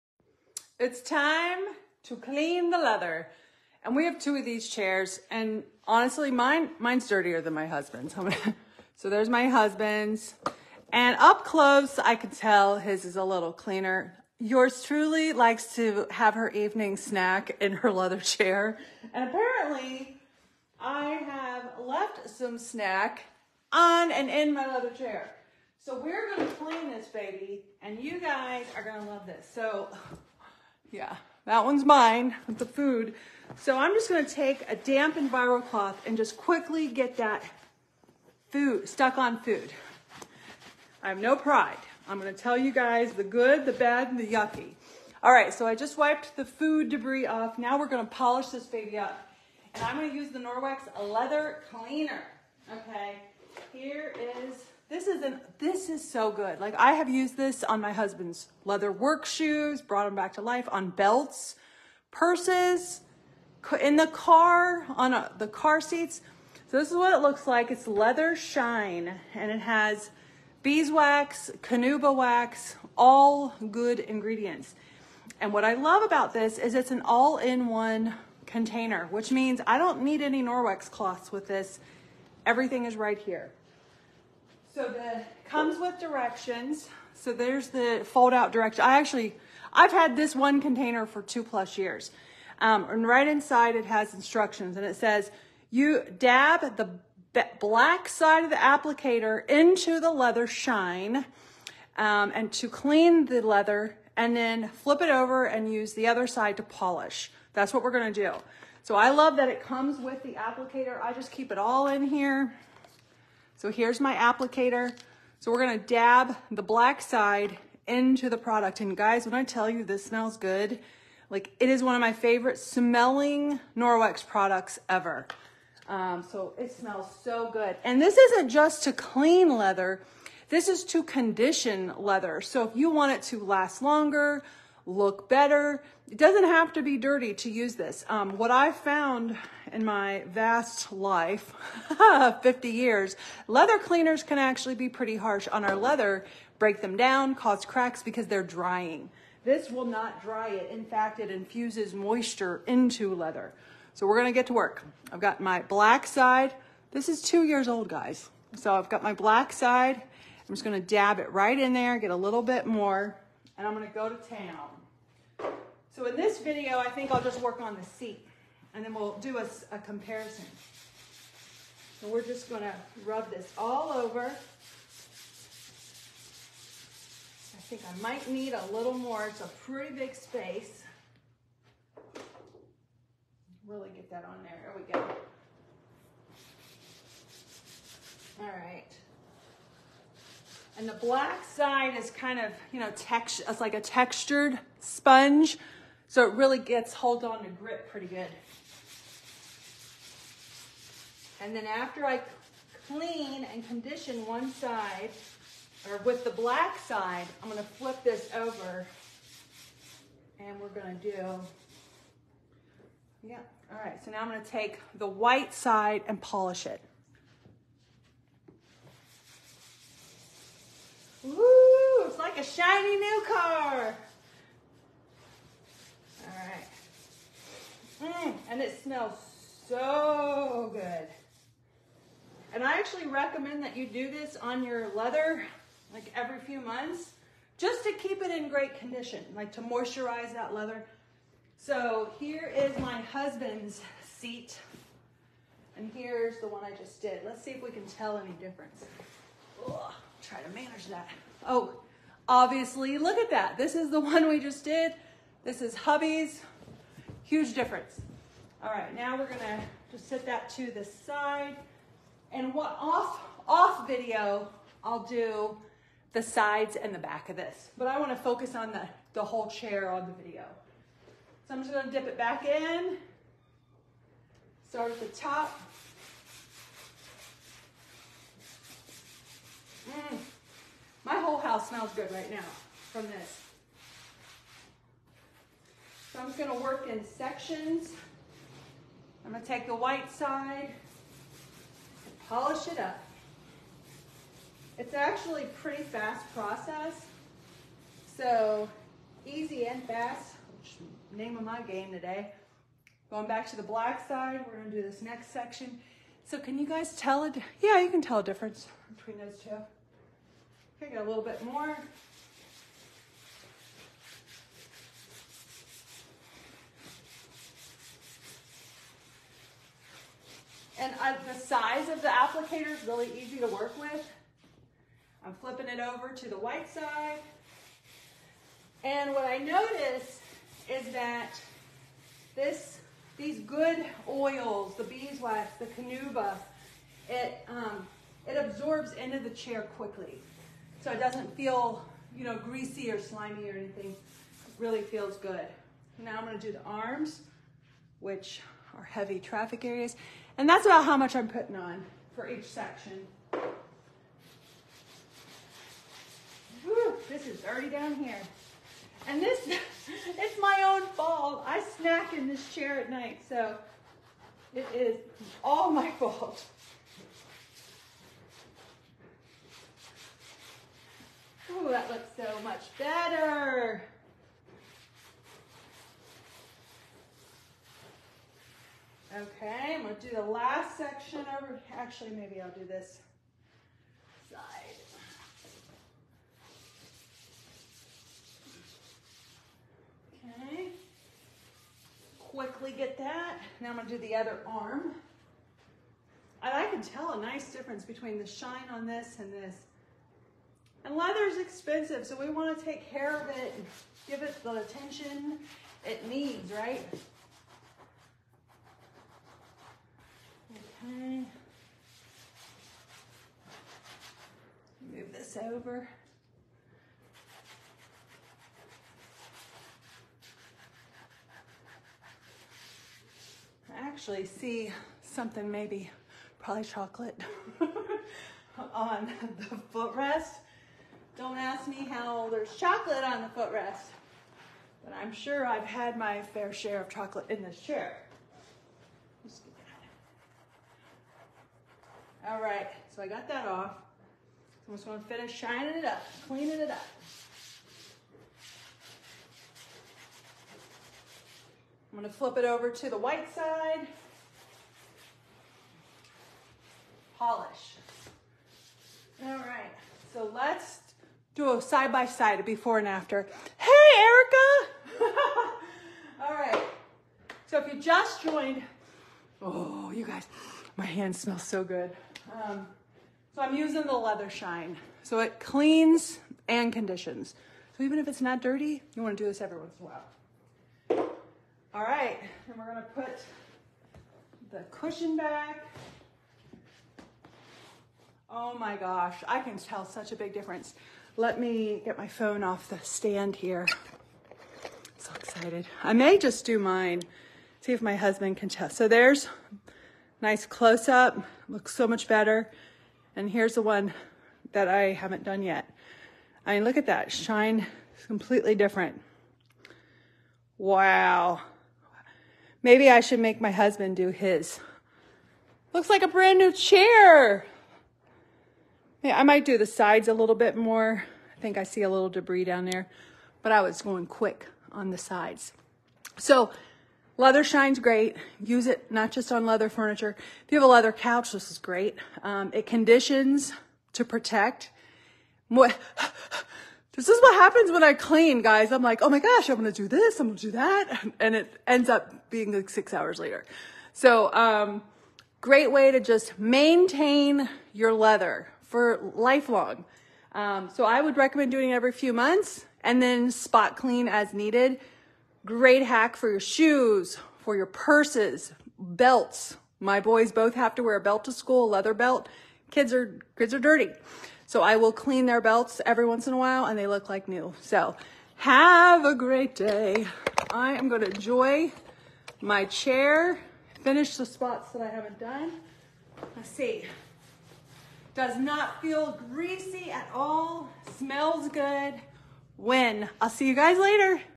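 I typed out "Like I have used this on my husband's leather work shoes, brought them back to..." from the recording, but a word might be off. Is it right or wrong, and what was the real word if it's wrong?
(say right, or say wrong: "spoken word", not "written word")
right.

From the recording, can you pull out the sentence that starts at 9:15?
Great hack for your shoes, for your purses, belts.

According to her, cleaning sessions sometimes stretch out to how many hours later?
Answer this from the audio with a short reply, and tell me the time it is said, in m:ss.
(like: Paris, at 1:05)
6 hours, at 9:02.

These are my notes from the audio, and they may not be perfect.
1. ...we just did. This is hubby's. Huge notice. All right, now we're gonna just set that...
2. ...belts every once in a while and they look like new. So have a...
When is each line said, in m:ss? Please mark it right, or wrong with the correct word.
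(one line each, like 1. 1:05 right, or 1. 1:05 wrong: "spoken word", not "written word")
1. 4:14 wrong: "difference", not "notice"
2. 9:25 right.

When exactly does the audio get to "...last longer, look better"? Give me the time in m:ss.
2:13.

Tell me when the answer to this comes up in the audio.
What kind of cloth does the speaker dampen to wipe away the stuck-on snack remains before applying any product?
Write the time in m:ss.
0:35.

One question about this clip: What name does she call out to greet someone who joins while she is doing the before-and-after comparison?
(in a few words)
Erica.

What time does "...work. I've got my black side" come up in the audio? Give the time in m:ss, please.
2:34.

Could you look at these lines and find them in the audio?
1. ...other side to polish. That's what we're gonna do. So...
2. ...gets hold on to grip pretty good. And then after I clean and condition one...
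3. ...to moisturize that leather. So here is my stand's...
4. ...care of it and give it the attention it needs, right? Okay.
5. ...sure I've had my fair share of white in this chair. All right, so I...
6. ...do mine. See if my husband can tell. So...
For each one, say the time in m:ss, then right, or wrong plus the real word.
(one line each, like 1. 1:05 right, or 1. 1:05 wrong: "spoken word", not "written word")
1. 1:46 right
2. 3:16 right
3. 3:59 wrong: "husband", not "stand"
4. 6:42 right
5. 7:15 wrong: "chocolate", not "white"
6. 8:16 right.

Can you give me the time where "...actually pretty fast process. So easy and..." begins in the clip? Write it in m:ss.
4:54.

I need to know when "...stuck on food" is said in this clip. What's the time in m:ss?
0:38.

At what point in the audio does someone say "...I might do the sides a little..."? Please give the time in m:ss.
8:39.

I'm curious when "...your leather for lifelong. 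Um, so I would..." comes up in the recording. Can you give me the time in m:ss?
9:07.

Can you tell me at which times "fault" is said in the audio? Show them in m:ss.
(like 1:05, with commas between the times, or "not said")
6:00, 6:05.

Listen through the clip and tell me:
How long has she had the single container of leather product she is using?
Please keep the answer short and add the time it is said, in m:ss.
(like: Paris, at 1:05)
2 plus years, at 1:31.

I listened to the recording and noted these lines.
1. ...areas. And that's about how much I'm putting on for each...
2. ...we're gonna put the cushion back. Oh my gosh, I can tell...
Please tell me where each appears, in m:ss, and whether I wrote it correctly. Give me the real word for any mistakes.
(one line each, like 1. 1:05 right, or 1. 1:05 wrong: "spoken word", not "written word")
1. 5:49 right
2. 8:02 right.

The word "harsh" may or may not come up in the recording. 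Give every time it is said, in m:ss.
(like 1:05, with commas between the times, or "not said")
2:25.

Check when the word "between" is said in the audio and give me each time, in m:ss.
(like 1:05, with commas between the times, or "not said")
5:08, 6:37.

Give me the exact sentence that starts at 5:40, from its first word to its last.
So it doesn't feel, you know, greasy or slimy or anything.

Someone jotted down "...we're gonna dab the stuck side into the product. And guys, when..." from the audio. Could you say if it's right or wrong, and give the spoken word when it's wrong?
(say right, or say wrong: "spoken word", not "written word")
wrong: "black", not "stuck".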